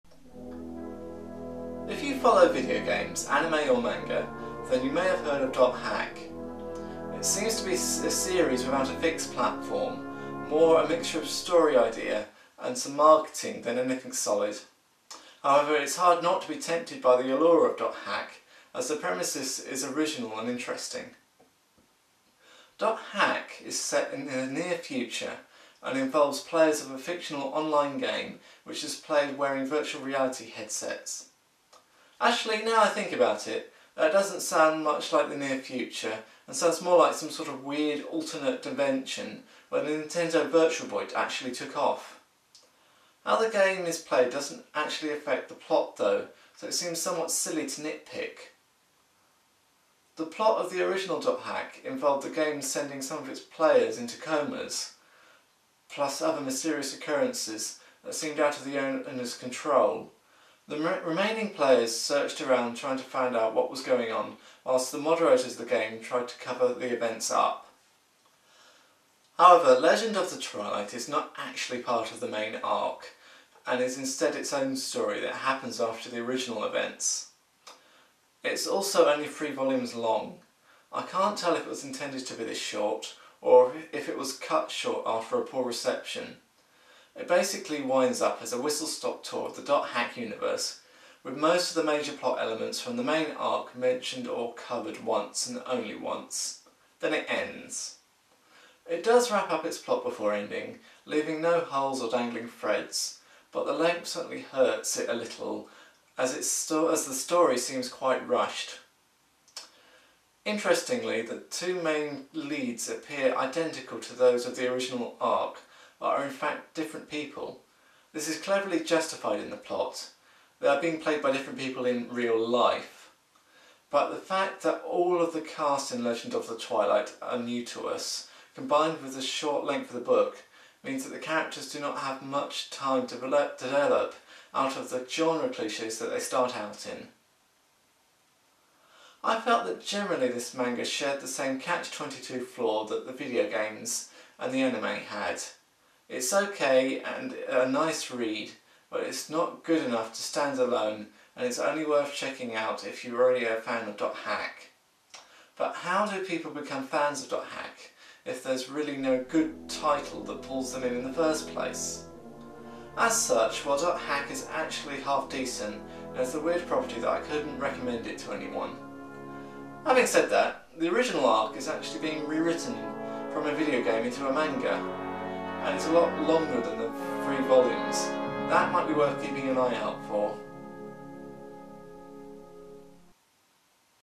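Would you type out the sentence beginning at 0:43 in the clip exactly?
How the game is played doesn't actually affect the plot though, so it seems somewhat silly to nitpick.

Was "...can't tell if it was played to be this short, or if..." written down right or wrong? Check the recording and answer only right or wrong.
wrong.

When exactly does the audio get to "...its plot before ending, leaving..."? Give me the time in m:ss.
1:39.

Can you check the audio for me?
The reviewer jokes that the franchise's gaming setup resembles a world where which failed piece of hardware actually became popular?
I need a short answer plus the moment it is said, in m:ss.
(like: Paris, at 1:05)
Nintendo Virtual Boy, at 0:39.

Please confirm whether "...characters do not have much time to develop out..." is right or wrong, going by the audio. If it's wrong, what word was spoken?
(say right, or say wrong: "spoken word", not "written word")
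right.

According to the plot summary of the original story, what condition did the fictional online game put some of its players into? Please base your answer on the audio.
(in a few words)
comas.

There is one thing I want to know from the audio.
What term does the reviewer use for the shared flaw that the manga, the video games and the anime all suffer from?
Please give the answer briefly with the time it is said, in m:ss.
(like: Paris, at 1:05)
catch-22, at 2:21.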